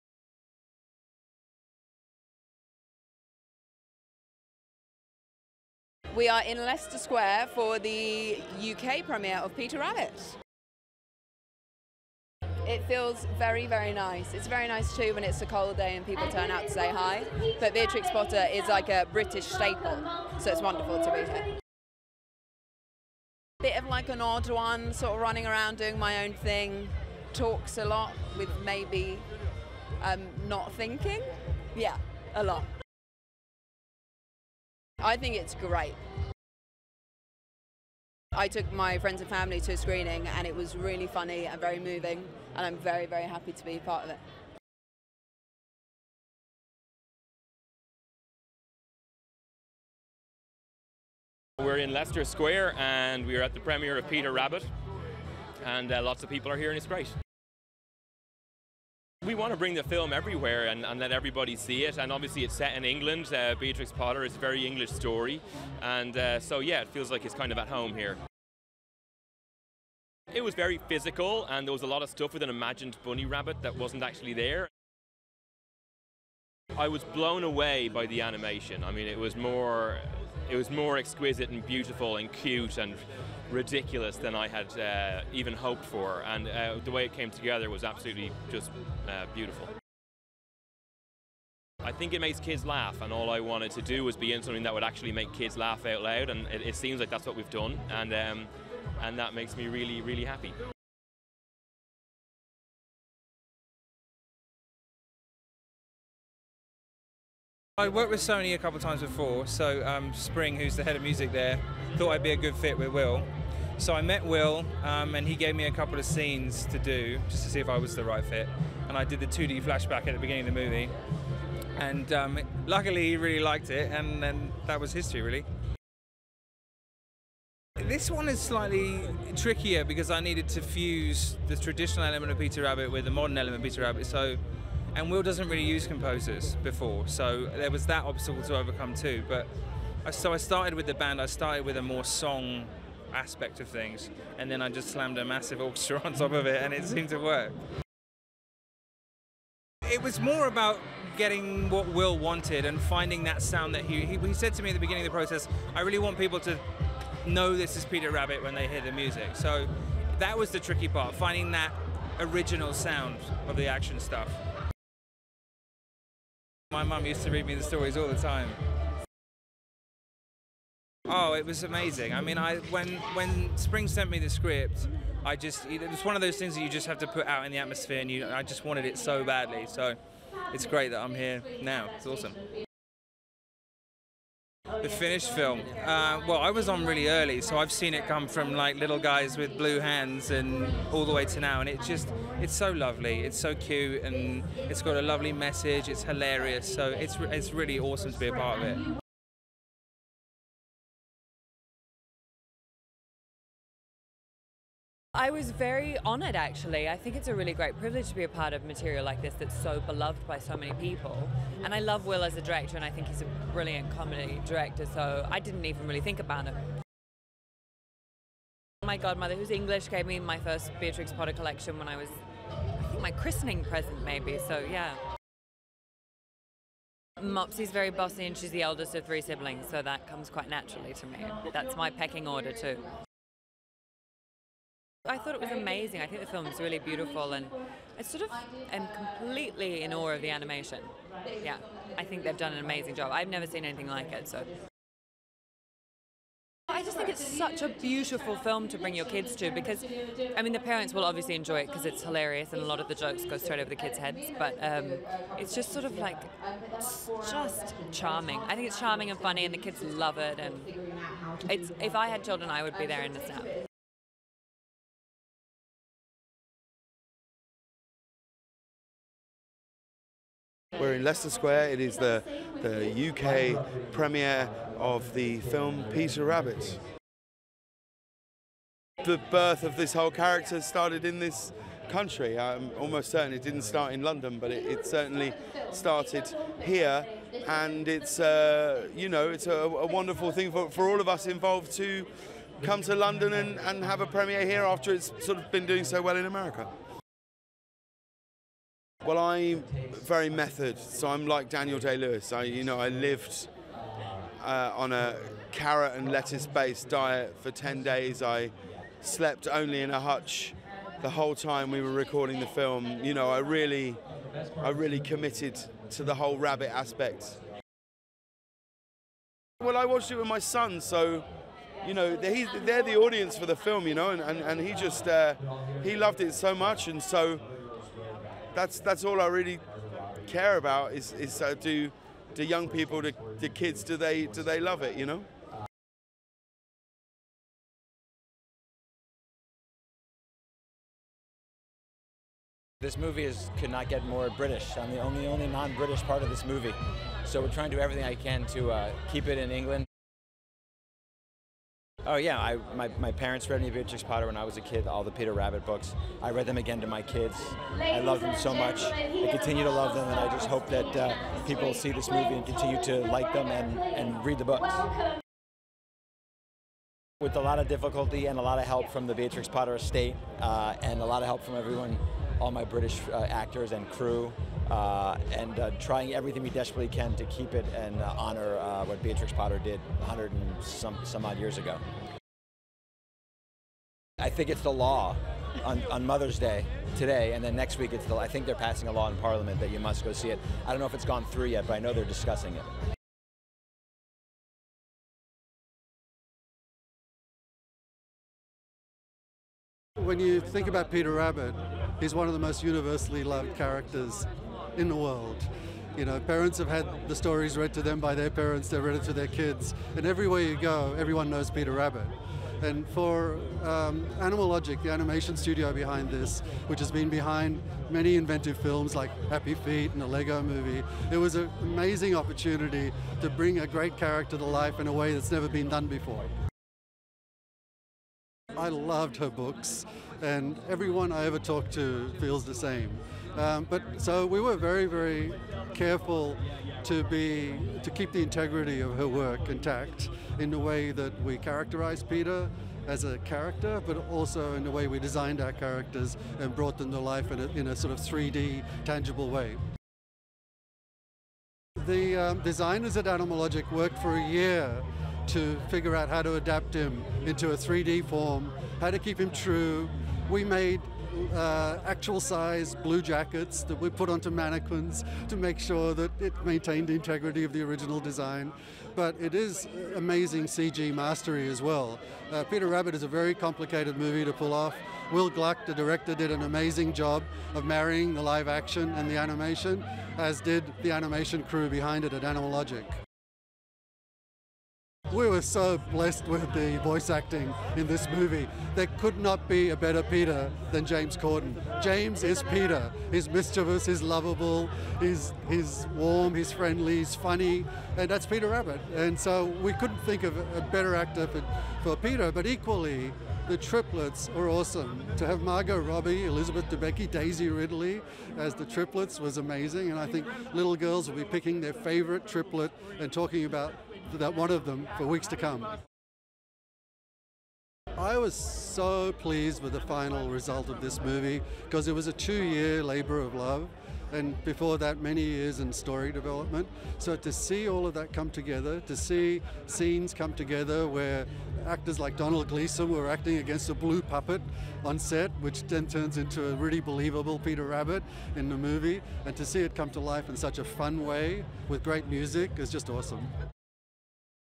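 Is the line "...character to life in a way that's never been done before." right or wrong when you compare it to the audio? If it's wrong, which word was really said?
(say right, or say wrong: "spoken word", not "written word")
right.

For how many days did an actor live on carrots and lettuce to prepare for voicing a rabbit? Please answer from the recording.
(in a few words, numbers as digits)
10.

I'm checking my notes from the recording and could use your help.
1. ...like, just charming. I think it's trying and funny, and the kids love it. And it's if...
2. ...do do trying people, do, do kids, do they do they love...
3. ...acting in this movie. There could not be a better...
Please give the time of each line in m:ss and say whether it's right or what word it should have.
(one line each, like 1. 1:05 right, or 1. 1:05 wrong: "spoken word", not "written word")
1. 4:15 wrong: "charming", not "trying"
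2. 5:31 wrong: "young", not "trying"
3. 8:07 right.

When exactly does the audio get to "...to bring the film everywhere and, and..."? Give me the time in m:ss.
0:59.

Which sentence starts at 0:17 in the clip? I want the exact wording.
But Beatrix Potter is like a British staple, so it's wonderful to be here.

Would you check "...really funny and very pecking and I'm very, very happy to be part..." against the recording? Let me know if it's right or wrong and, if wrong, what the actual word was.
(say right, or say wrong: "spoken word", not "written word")
wrong: "moving", not "pecking".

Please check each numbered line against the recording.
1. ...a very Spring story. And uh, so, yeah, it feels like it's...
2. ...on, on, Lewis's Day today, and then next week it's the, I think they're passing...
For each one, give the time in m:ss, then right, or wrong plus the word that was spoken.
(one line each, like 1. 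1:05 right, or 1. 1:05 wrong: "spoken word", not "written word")
1. 1:04 wrong: "English", not "Spring"
2. 6:25 wrong: "Mother", not "Lewis".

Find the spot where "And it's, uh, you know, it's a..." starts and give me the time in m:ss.
4:47.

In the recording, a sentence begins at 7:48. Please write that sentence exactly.
But it is amazing CG mastery as well.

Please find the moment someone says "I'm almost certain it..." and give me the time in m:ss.
4:42.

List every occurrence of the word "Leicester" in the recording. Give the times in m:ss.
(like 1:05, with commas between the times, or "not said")
0:06, 0:51, 4:31.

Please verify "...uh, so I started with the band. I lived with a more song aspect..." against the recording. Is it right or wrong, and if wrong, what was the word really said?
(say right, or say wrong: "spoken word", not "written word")
wrong: "started", not "lived".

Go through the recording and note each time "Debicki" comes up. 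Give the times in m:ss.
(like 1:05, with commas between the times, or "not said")
8:26.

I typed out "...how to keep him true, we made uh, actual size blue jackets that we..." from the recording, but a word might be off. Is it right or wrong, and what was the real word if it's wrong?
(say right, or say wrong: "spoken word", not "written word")
right.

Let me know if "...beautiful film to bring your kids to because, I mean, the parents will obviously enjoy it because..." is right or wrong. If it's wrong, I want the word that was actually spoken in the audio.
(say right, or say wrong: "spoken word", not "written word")
right.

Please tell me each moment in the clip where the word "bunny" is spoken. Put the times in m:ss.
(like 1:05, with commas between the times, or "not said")
1:13.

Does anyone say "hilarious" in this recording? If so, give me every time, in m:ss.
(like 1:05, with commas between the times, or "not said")
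3:16, 4:12.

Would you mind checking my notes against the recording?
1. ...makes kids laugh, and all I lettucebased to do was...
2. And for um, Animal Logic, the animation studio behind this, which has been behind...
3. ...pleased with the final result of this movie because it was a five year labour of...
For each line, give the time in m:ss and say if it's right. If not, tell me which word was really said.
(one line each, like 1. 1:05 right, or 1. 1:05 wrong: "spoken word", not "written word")
1. 1:32 wrong: "wanted", not "lettucebased"
2. 6:52 right
3. 8:39 wrong: "two", not "five".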